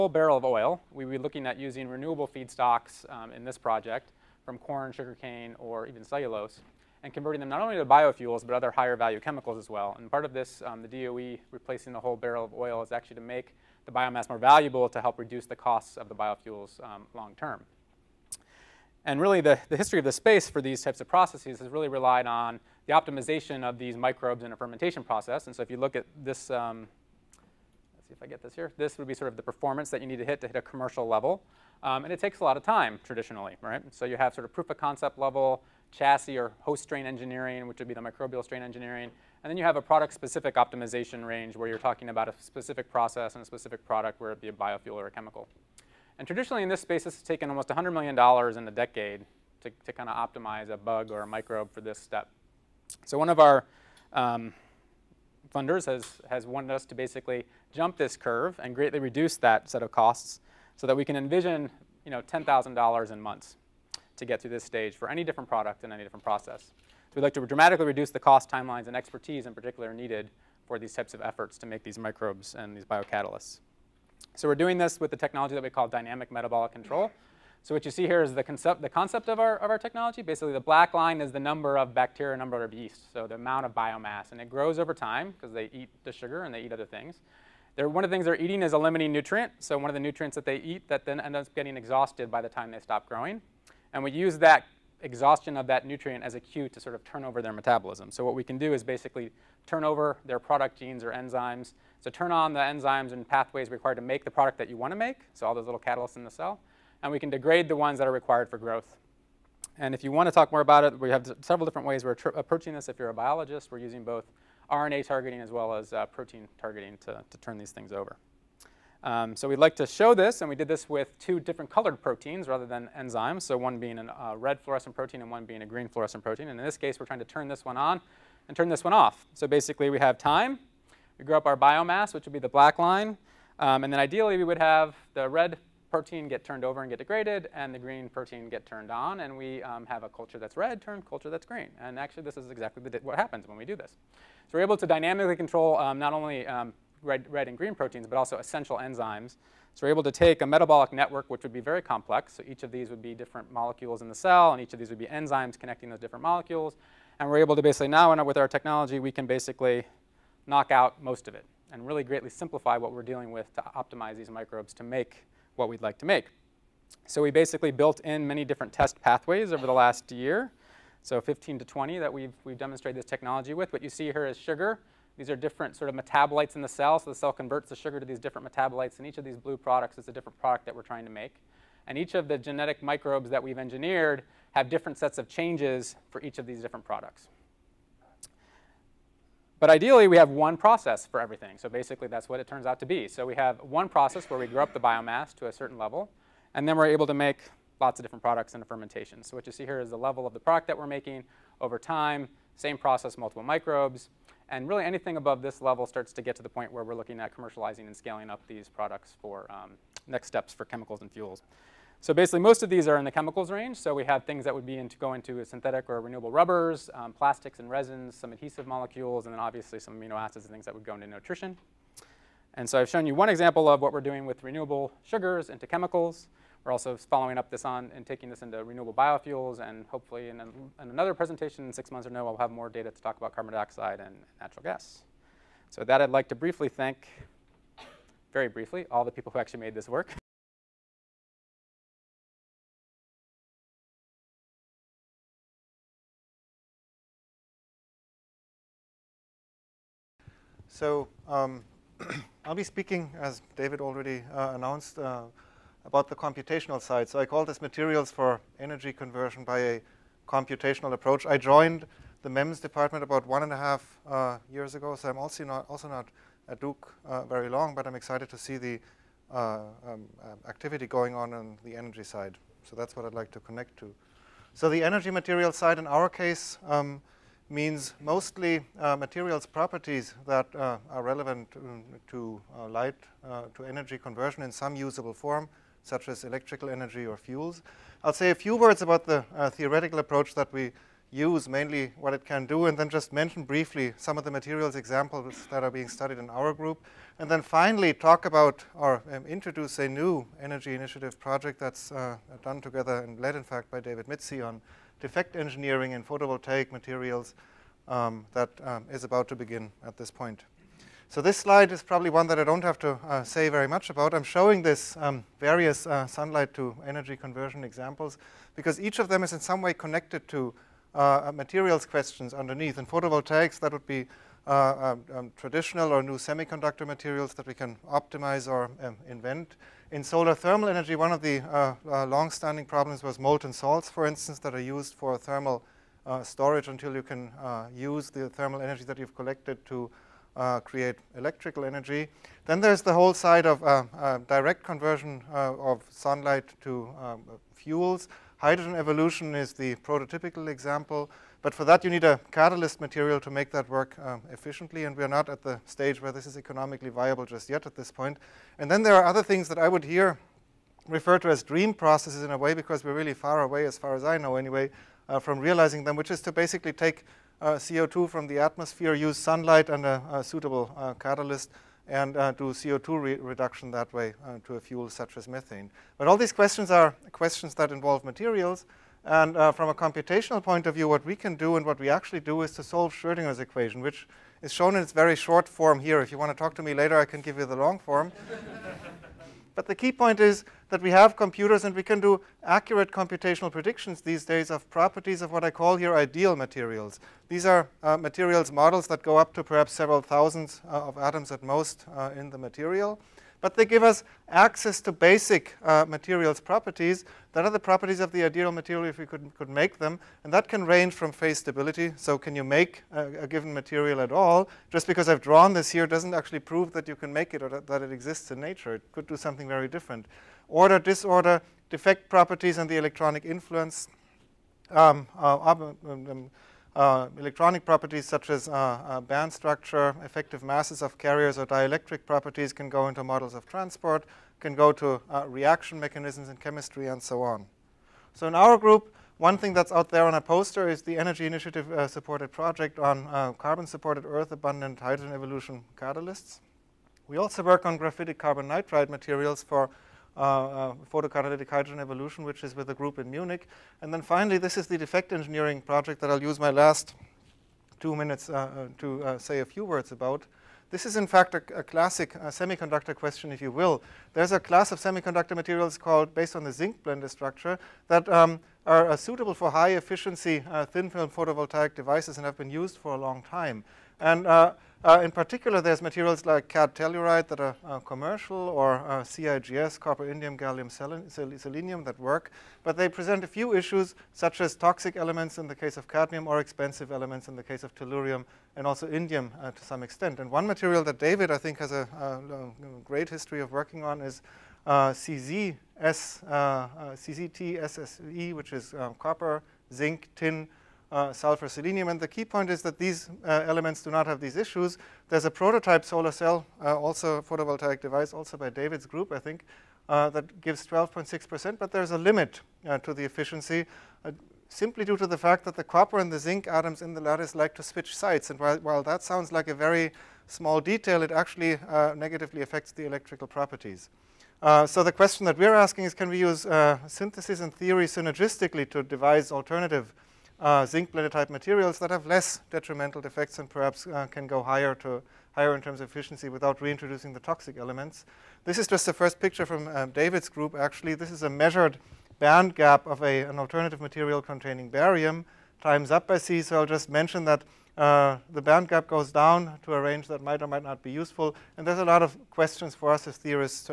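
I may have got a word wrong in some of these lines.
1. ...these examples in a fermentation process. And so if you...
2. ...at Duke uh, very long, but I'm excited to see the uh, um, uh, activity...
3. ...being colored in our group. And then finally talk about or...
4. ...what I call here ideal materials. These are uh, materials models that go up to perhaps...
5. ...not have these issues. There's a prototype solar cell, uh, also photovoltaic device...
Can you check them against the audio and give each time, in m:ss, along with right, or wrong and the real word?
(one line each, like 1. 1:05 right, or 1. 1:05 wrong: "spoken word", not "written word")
1. 0:23 wrong: "microbes", not "examples"
2. 4:26 right
3. 4:55 wrong: "studied", not "colored"
4. 6:35 right
5. 8:23 right.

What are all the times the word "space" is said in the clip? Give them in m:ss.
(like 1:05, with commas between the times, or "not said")
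0:20, 0:46.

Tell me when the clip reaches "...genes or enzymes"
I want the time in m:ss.
1:40.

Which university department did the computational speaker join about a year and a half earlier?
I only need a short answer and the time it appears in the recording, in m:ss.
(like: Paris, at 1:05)
MEMS, at 4:22.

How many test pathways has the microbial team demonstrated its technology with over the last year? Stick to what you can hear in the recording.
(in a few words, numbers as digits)
15 to 20.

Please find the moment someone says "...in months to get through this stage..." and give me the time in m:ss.
1:03.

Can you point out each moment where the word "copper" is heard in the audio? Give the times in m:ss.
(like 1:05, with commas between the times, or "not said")
7:59, 8:18, 8:35.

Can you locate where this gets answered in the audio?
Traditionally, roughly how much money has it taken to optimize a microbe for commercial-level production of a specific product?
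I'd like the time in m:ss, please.
0:47.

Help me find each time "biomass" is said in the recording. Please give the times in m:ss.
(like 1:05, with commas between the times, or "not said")
0:13, 1:23, 2:11, 3:14.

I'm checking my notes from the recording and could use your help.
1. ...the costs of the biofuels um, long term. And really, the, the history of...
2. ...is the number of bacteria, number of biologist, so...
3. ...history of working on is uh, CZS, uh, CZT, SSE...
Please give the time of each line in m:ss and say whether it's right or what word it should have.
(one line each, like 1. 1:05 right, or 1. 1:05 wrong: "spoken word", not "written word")
1. 0:15 right
2. 1:21 wrong: "yeast", not "biologist"
3. 8:13 right.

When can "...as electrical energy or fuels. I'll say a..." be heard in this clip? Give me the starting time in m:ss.
4:46.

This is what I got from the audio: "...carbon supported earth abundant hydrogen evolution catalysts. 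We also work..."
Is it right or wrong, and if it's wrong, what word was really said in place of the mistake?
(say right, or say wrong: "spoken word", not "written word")
right.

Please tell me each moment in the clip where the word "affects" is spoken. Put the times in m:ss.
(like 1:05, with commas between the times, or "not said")
8:42.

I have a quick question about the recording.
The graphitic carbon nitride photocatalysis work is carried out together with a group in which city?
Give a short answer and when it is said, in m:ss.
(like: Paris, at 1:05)
Munich, at 7:33.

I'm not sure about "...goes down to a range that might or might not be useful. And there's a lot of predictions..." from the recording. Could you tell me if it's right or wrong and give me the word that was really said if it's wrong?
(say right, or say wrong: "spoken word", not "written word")
wrong: "questions", not "predictions".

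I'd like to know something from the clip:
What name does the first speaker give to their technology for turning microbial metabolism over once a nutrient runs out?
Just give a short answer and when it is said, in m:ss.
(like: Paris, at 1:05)
dynamic metabolic control, at 1:15.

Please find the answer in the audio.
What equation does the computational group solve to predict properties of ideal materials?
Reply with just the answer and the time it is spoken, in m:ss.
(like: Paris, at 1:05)
Schrodinger's equation, at 6:22.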